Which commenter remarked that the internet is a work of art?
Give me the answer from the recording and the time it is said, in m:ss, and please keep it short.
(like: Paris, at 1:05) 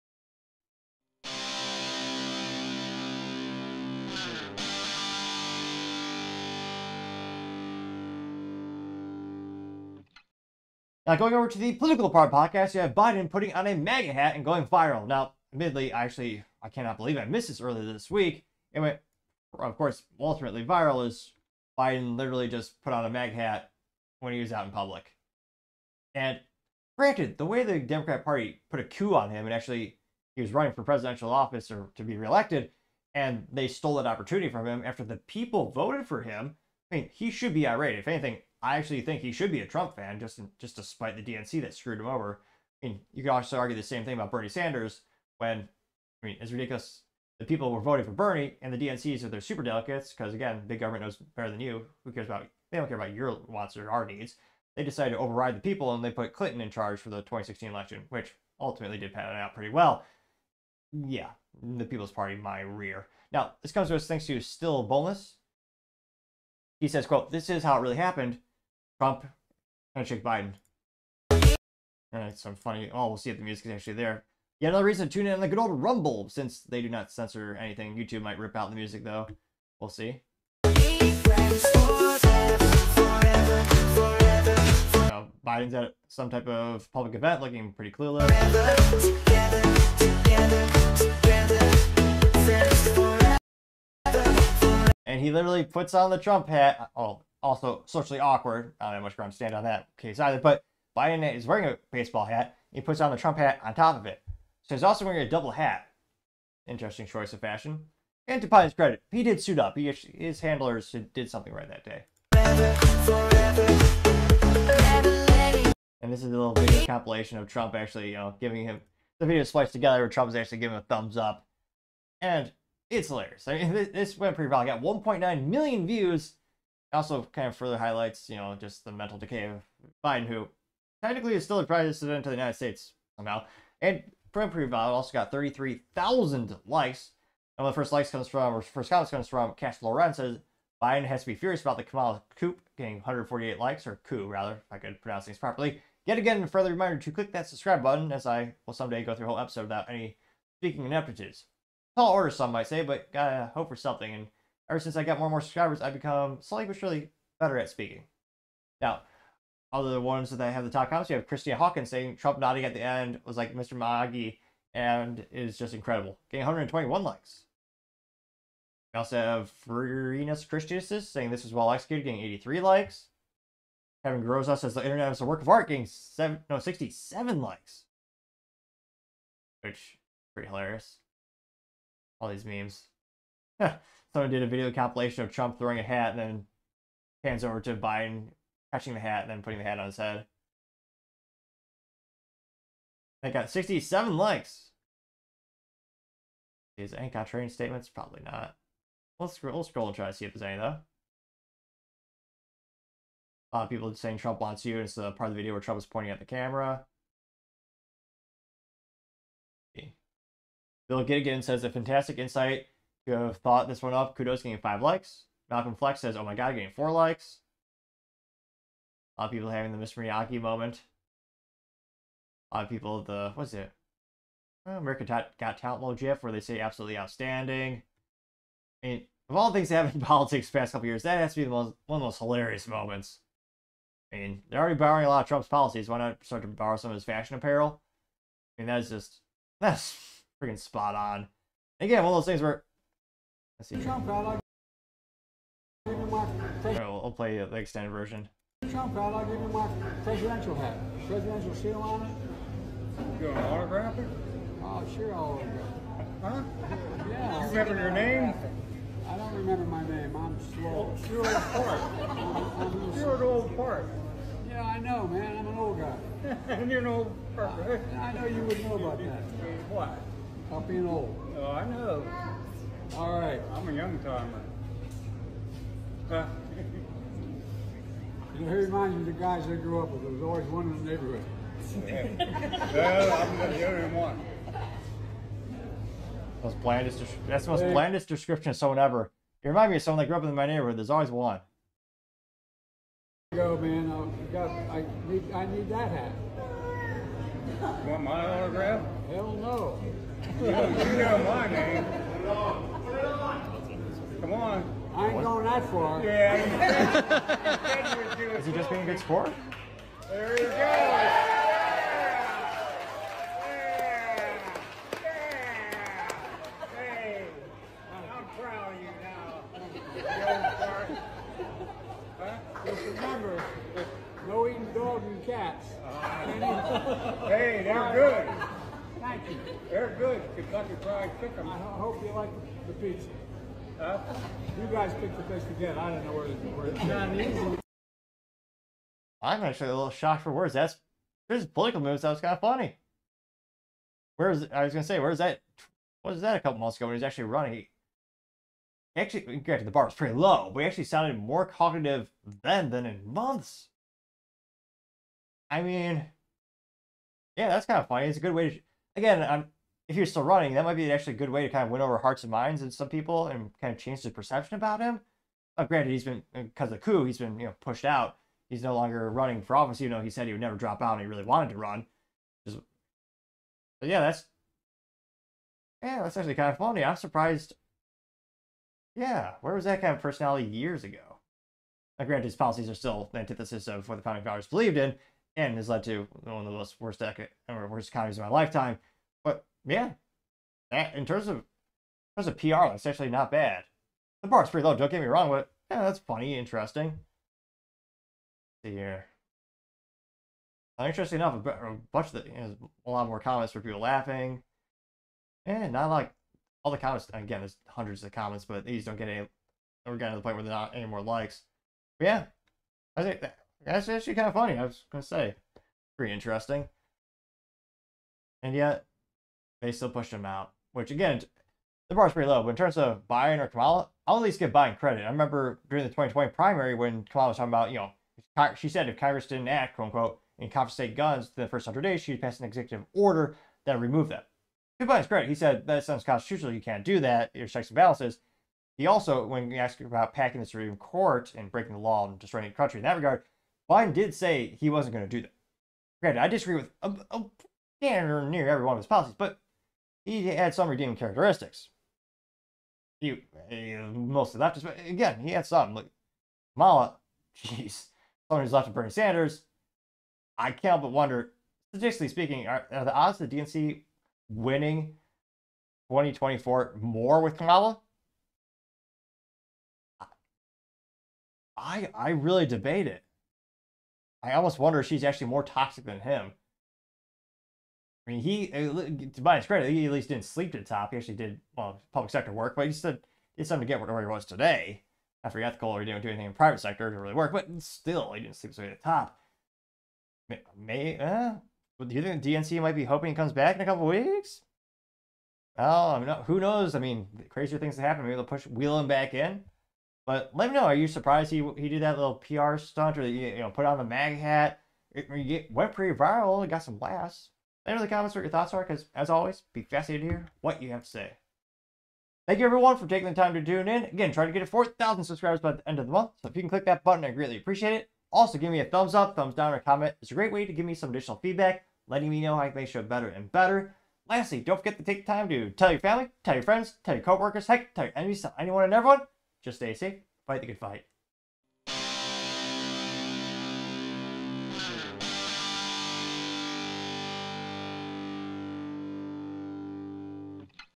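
Kevin Groza, at 2:54.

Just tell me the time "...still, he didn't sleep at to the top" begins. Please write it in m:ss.
8:07.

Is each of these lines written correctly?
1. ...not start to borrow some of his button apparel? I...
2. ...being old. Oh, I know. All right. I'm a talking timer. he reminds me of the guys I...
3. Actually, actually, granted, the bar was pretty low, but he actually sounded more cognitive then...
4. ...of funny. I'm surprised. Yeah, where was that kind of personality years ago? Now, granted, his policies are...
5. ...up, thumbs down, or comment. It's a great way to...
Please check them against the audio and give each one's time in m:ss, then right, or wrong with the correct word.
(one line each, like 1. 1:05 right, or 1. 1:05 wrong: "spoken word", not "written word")
1. 3:55 wrong: "fashion", not "button"
2. 4:30 wrong: "young", not "talking"
3. 5:48 right
4. 6:16 right
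5. 8:38 right.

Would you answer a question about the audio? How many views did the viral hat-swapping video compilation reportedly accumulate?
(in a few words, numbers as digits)
1.9 million.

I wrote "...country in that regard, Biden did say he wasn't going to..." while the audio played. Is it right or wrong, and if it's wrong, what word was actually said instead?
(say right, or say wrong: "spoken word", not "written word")
right.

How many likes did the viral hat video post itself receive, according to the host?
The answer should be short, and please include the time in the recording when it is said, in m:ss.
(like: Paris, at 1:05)
33,000, at 2:15.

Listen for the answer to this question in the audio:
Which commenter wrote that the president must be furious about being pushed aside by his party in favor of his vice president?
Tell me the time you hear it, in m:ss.
2:19.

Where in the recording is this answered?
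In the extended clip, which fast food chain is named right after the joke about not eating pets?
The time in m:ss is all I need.
5:30.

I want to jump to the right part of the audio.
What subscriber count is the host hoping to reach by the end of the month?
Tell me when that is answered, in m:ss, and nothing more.
8:34.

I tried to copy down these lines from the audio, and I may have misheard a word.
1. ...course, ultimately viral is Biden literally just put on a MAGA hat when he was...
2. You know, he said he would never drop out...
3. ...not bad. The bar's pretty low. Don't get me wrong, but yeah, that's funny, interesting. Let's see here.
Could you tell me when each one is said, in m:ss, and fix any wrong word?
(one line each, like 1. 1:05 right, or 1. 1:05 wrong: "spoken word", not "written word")
1. 0:19 right
2. 6:09 right
3. 6:33 right.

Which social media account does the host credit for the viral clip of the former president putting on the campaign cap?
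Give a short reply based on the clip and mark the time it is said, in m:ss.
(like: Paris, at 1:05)
Still Boneless, at 1:04.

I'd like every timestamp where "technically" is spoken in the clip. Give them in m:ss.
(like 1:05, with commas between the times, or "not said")
2:11.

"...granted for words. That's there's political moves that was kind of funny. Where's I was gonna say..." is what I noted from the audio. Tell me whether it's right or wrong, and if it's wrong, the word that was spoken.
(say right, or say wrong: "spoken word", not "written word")
wrong: "shocked", not "granted".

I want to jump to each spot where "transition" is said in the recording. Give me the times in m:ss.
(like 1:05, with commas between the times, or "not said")
not said.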